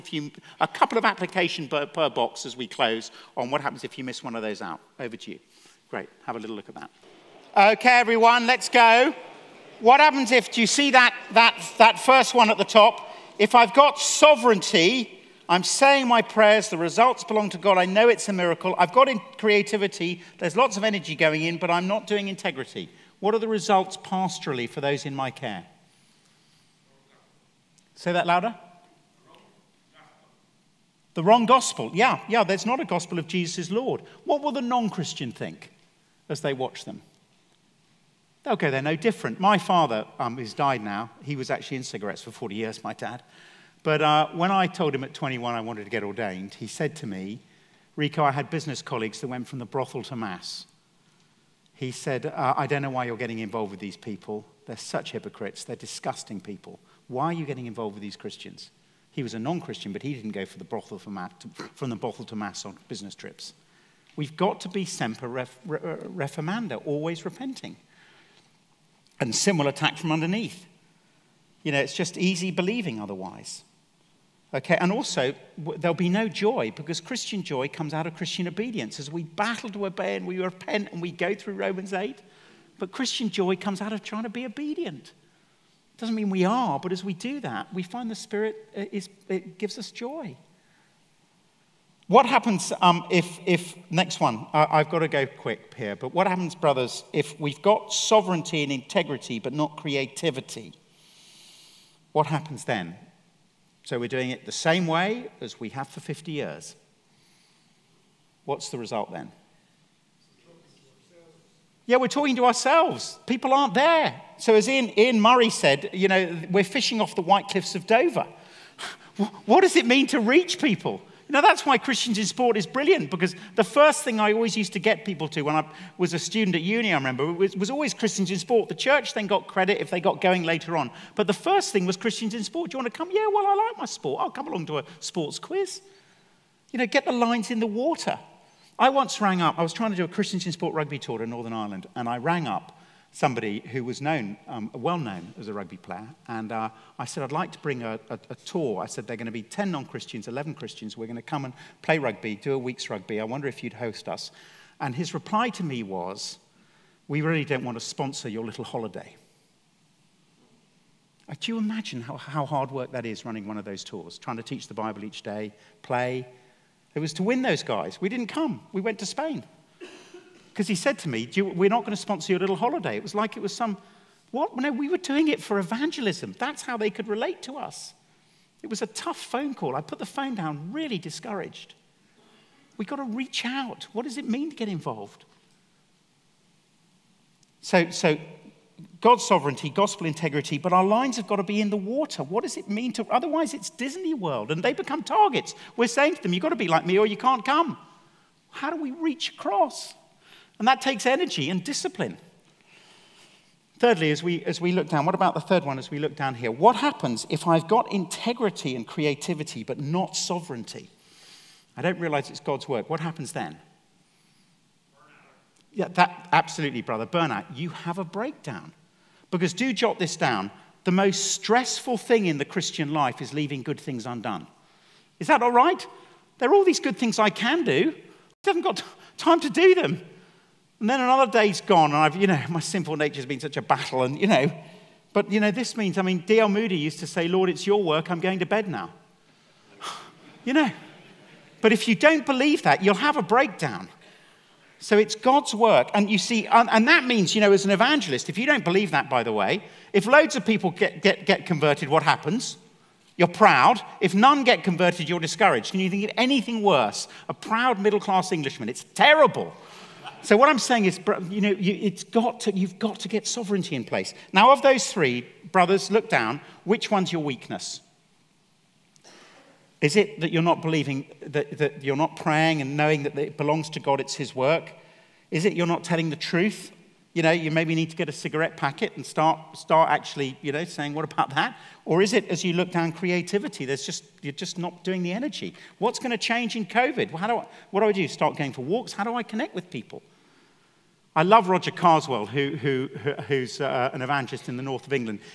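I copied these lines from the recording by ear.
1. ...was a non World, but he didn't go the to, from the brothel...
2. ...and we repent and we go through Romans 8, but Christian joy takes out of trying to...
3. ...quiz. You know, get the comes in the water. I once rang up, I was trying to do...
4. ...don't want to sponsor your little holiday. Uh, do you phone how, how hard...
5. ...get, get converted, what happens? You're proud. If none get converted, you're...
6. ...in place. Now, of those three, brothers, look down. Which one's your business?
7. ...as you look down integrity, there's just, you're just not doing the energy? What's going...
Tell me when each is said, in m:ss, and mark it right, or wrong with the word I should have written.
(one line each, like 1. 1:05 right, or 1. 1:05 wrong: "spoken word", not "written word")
1. 0:59 wrong: "Christian", not "World"
2. 1:20 wrong: "comes", not "takes"
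3. 2:15 wrong: "lines", not "comes"
4. 2:37 wrong: "imagine", not "phone"
5. 4:11 right
6. 4:23 wrong: "weakness", not "business"
7. 4:42 wrong: "creativity", not "integrity".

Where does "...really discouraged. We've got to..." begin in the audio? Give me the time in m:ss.
3:00.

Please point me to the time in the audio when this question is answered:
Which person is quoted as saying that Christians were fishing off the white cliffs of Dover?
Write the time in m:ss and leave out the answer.
1:54.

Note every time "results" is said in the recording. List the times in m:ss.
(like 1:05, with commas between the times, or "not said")
0:16, 0:23, 1:48.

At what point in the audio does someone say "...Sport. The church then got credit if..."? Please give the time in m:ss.
2:08.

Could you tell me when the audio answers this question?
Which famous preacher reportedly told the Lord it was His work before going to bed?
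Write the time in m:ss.
3:56.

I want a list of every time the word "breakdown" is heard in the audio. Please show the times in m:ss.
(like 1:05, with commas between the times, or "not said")
3:38, 4:03.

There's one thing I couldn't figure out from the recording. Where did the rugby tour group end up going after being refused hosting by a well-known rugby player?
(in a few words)
Spain.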